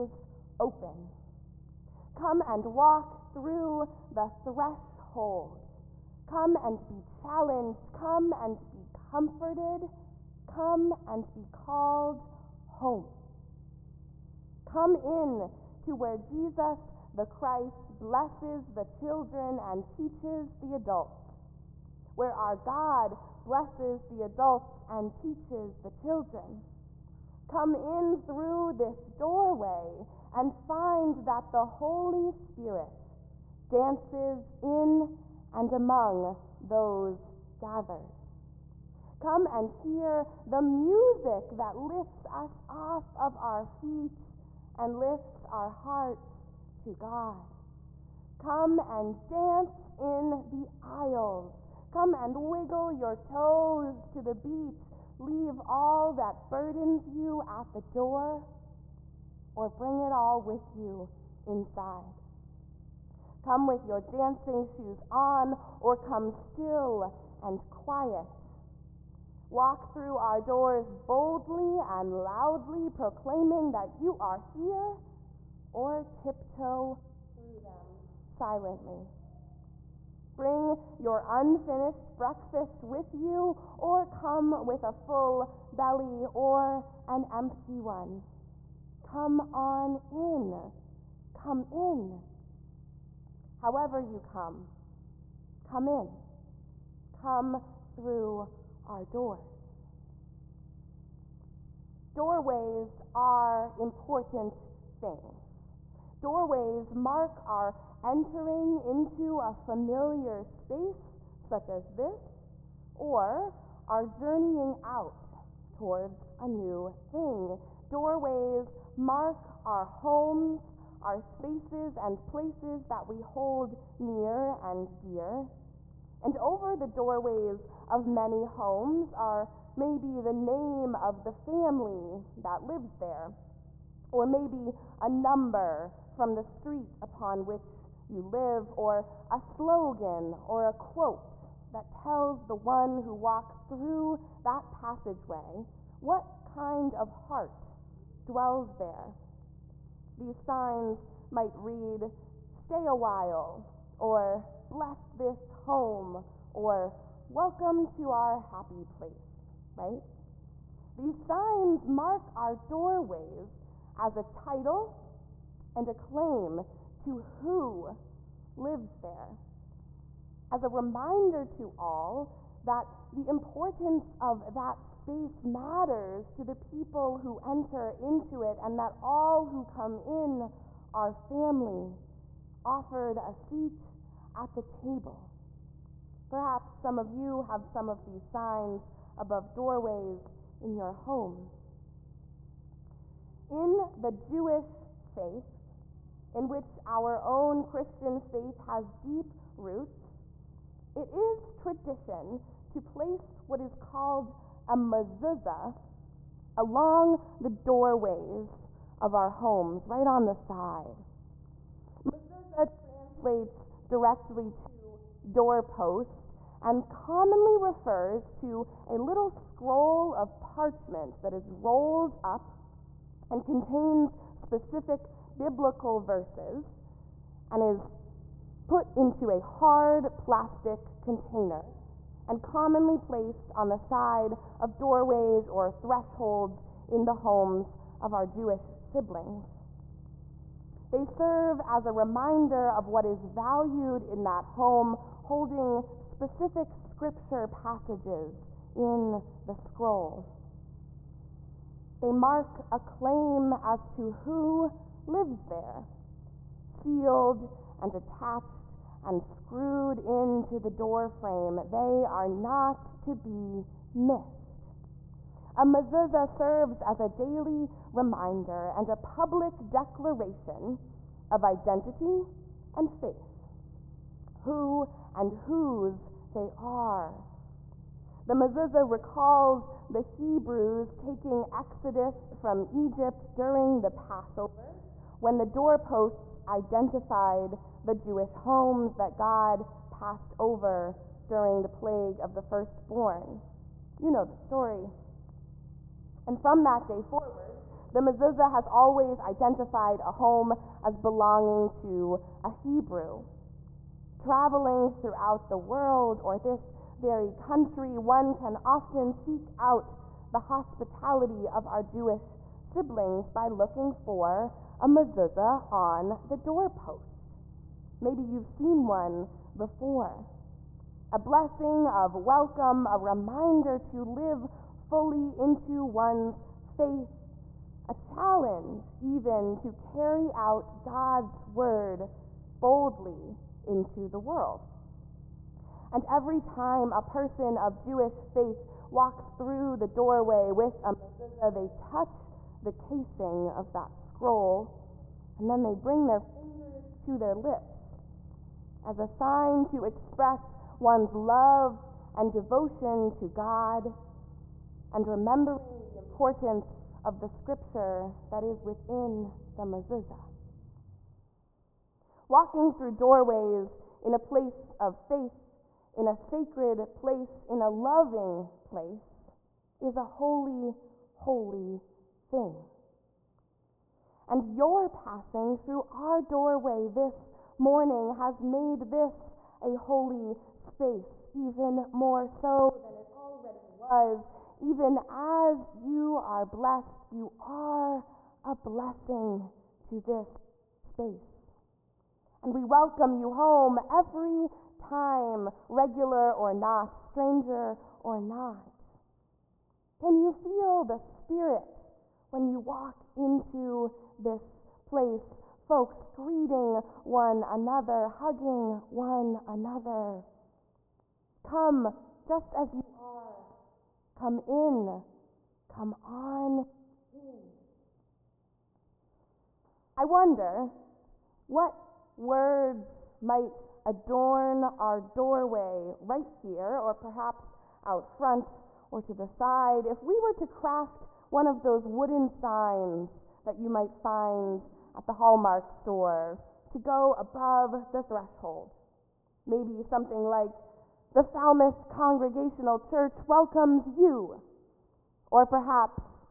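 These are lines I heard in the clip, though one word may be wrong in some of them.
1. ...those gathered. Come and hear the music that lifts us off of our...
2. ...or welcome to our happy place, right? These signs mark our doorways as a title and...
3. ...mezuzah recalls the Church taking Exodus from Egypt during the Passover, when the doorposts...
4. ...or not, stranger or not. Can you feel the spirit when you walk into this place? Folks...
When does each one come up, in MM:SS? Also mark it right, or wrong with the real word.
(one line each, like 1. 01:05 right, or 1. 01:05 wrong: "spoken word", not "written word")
1. 00:36 right
2. 02:36 right
3. 04:38 wrong: "Hebrews", not "Church"
4. 06:36 right.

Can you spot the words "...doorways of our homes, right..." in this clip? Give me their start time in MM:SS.
03:27.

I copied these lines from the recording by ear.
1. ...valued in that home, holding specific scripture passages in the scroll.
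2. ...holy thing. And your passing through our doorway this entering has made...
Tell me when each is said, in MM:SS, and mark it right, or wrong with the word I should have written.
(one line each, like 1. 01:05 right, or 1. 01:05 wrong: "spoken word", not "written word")
1. 04:03 right
2. 06:11 wrong: "morning", not "entering".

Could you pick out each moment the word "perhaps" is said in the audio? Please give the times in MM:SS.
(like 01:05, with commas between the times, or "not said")
03:06, 07:06, 07:25.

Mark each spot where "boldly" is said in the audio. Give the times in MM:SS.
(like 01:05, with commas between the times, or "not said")
01:11, 05:32.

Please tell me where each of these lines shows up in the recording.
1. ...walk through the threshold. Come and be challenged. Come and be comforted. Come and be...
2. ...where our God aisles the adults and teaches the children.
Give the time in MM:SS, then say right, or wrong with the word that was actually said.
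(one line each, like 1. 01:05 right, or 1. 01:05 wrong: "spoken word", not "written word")
1. 00:02 right
2. 00:22 wrong: "blesses", not "aisles".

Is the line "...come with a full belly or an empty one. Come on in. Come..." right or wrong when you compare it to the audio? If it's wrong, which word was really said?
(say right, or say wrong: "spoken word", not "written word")
right.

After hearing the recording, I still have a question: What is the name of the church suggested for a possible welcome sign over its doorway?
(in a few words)
Falmouth Congregational Church.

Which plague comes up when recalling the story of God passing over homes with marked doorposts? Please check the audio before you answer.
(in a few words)
plague of the firstborn.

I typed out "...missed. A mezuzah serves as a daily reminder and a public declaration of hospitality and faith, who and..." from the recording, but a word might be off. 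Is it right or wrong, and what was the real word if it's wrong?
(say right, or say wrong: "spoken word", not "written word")
wrong: "identity", not "hospitality".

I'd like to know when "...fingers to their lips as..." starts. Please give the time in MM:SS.
05:46.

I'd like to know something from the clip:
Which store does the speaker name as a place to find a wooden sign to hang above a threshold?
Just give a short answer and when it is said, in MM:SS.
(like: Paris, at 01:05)
Hallmark, at 07:15.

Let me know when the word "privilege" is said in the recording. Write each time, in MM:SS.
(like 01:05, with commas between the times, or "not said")
not said.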